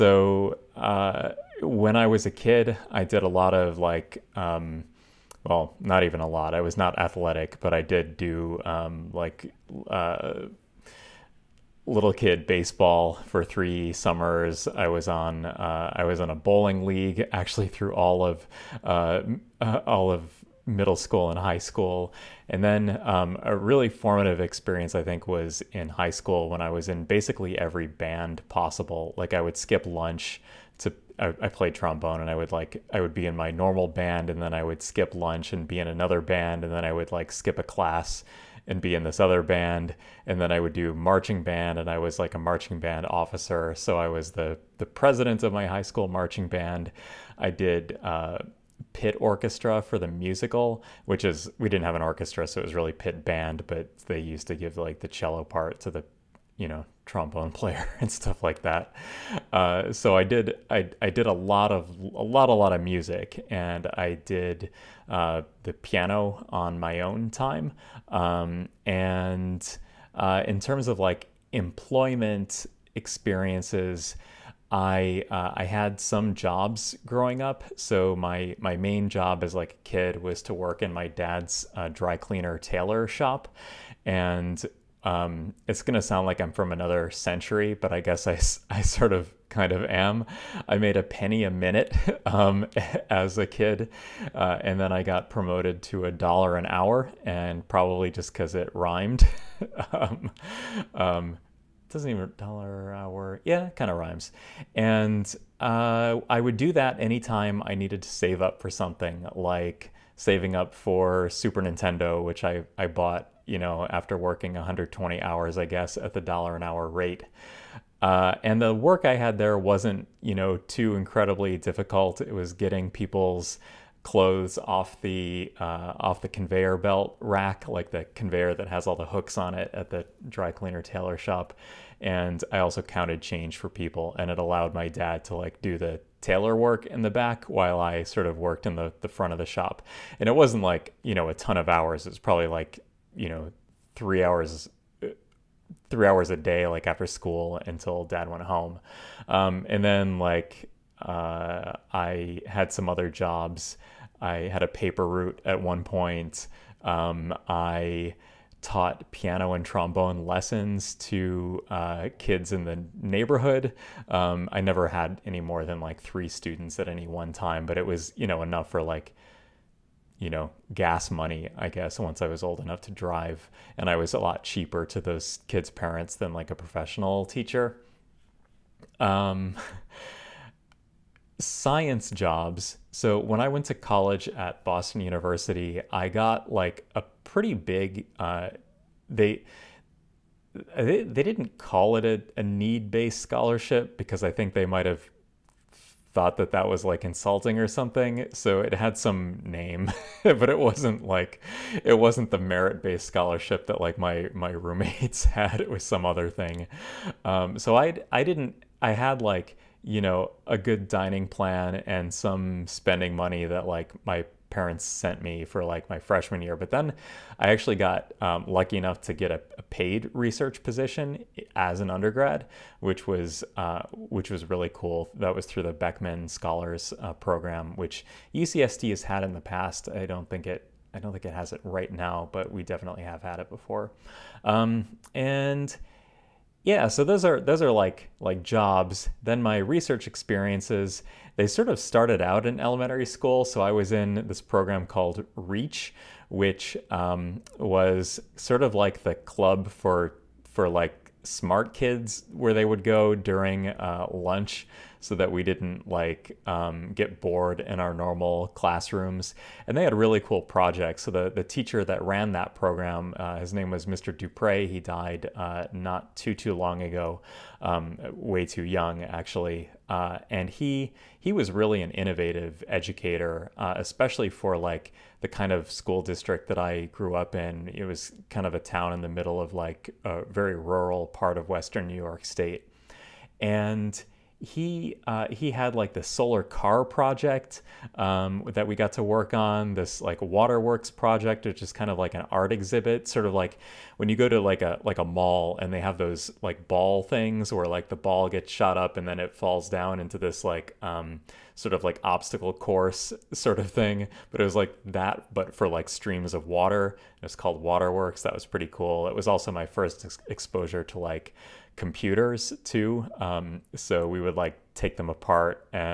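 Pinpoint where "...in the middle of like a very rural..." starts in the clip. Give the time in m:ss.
4:38.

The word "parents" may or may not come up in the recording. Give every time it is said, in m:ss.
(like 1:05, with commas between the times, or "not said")
2:55, 3:34.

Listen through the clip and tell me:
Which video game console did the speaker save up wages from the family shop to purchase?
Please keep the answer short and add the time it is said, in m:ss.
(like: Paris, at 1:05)
Super Nintendo, at 1:51.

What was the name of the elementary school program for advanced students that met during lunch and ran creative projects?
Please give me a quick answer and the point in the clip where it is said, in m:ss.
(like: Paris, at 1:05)
REACH, at 4:05.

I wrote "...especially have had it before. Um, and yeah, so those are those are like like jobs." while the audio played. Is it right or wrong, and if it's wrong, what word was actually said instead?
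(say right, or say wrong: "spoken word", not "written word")
wrong: "definitely", not "especially".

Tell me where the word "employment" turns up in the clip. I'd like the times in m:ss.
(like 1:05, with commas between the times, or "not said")
1:11.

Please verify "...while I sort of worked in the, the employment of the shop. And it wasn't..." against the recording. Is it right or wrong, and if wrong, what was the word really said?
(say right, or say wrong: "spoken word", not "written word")
wrong: "front", not "employment".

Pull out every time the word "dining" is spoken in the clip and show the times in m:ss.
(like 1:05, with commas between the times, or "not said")
3:30.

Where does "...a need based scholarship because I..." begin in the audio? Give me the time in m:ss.
3:12.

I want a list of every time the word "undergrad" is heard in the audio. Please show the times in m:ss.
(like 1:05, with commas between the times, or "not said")
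3:41.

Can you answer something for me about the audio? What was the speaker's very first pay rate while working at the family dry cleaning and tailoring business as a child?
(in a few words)
a penny a minute.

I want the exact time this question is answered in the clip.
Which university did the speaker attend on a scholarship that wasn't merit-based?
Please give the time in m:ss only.
3:04.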